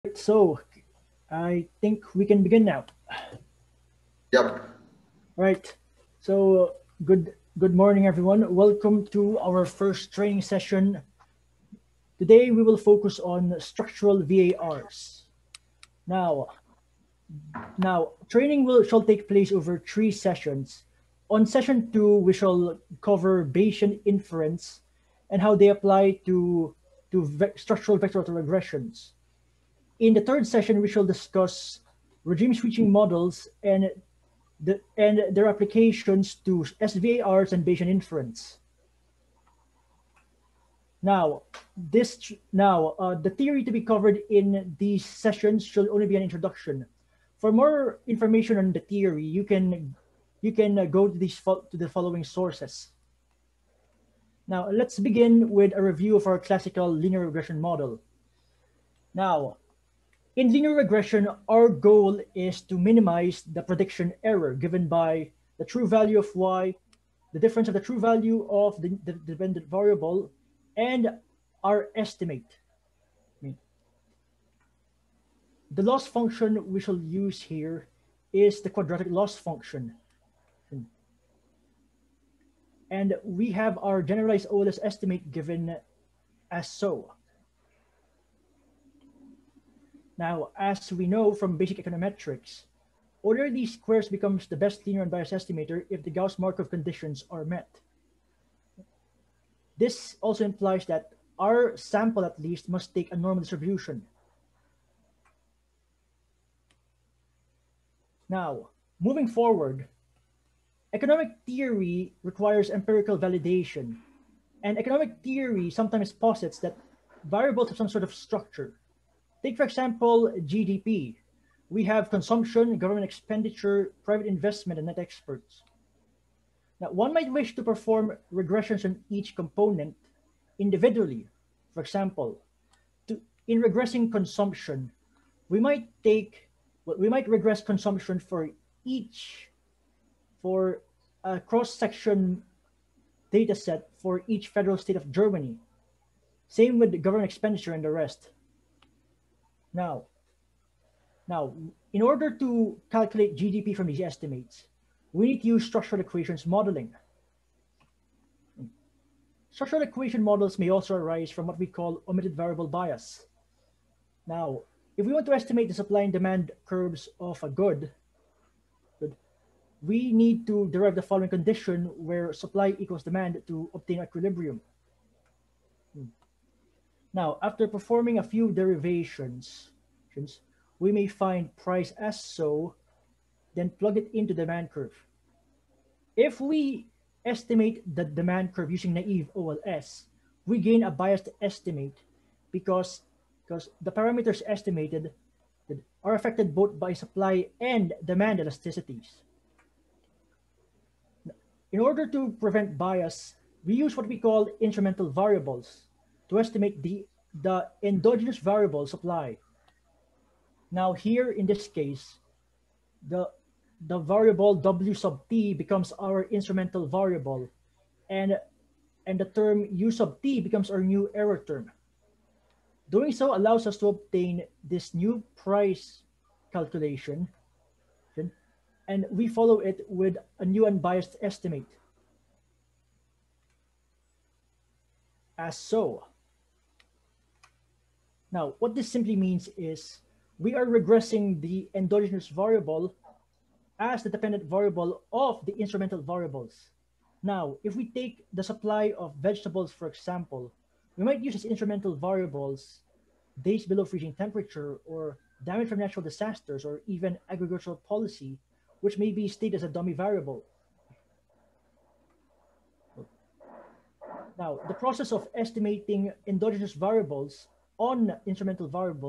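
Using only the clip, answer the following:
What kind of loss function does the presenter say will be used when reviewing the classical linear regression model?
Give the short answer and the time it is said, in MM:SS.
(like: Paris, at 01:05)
Quadratic loss function, at 01:18.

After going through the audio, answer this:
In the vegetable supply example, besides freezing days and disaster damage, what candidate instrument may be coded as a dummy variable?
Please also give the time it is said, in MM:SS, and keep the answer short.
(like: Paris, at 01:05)
Agricultural policy, at 04:17.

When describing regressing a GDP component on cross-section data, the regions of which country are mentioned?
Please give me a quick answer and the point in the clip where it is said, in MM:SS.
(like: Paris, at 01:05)
Germany, at 02:25.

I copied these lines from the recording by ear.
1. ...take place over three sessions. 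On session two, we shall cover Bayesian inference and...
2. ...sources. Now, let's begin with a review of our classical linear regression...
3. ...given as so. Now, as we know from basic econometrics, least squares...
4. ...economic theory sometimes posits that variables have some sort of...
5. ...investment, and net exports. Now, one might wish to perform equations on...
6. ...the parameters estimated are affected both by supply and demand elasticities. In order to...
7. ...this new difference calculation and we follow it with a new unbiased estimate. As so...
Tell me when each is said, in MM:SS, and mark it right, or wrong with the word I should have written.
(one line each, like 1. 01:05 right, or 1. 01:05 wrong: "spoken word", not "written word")
1. 00:19 right
2. 00:52 right
3. 01:25 right
4. 01:54 right
5. 02:04 wrong: "regressions", not "equations"
6. 03:13 right
7. 03:44 wrong: "price", not "difference".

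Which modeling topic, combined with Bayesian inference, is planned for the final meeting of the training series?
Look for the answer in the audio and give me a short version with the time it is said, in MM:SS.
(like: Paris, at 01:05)
Regime switching models, at 00:32.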